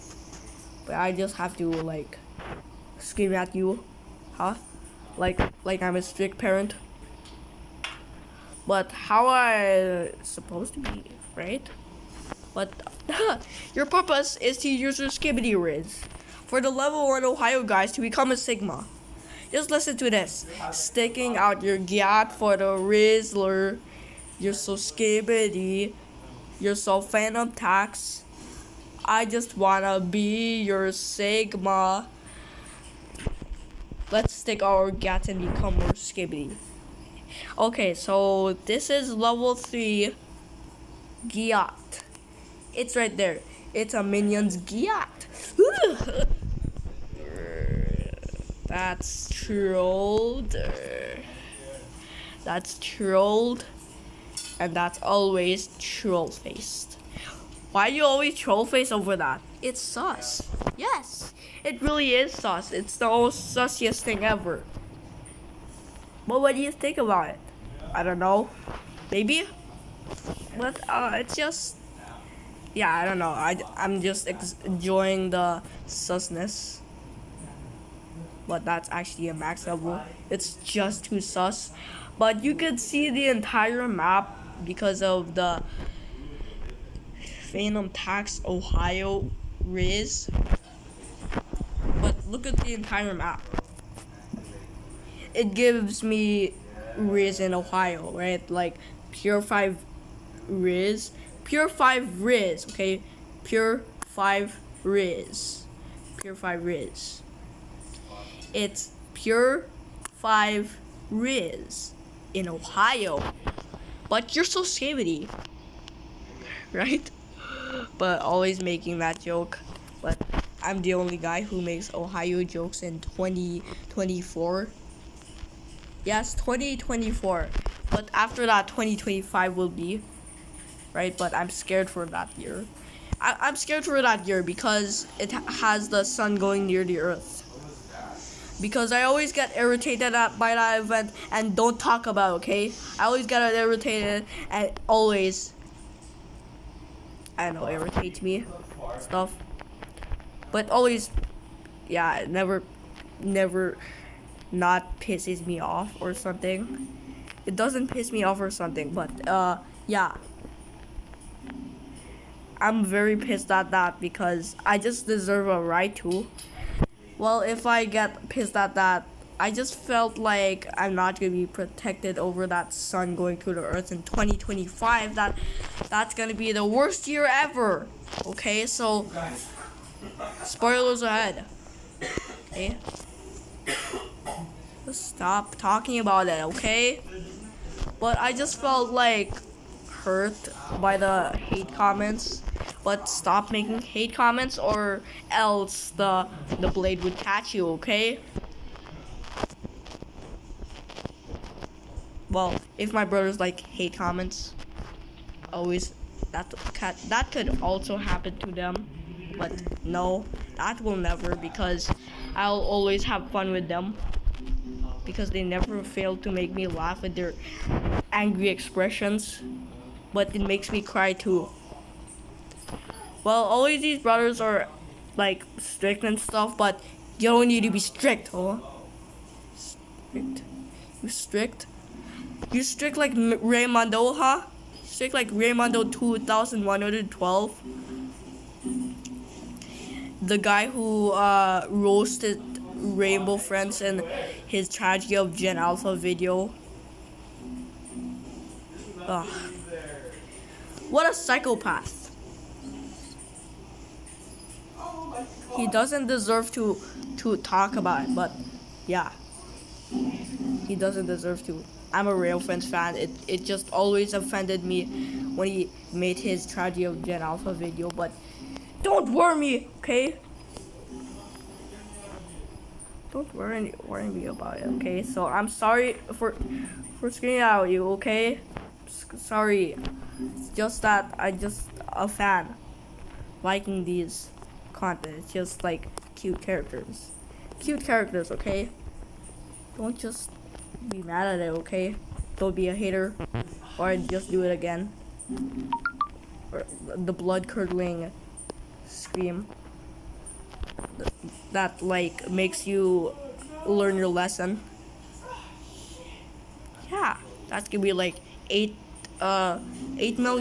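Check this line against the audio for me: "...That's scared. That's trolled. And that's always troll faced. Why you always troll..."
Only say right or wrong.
wrong.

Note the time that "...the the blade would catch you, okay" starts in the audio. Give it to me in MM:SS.
03:15.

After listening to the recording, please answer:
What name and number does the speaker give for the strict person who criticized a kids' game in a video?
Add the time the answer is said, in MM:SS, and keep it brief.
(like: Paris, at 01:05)
Raimondo 2112, at 03:55.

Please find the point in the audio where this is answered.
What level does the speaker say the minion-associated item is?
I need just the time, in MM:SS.
00:39.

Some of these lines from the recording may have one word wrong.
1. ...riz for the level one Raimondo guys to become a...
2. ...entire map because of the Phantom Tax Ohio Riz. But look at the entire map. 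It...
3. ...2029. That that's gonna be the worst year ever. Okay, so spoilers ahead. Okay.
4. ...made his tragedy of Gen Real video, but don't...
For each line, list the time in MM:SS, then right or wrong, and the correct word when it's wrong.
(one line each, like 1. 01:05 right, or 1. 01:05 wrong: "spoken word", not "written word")
1. 00:15 wrong: "Ohio", not "Raimondo"
2. 01:23 right
3. 02:54 wrong: "2025", not "2029"
4. 04:25 wrong: "Alpha", not "Real".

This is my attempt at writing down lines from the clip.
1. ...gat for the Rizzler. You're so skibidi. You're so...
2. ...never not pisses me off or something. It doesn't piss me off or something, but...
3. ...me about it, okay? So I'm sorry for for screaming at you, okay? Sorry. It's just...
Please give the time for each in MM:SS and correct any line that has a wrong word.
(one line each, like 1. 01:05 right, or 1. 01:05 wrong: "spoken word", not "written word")
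1. 00:21 right
2. 02:33 right
3. 04:34 right.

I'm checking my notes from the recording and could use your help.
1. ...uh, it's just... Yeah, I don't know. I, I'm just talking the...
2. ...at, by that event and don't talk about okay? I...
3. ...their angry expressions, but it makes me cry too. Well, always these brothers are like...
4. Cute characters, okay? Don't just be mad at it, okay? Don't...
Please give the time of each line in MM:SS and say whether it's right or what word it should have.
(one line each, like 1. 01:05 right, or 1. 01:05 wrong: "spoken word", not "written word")
1. 01:10 wrong: "enjoying", not "talking"
2. 02:20 right
3. 03:37 right
4. 04:47 right.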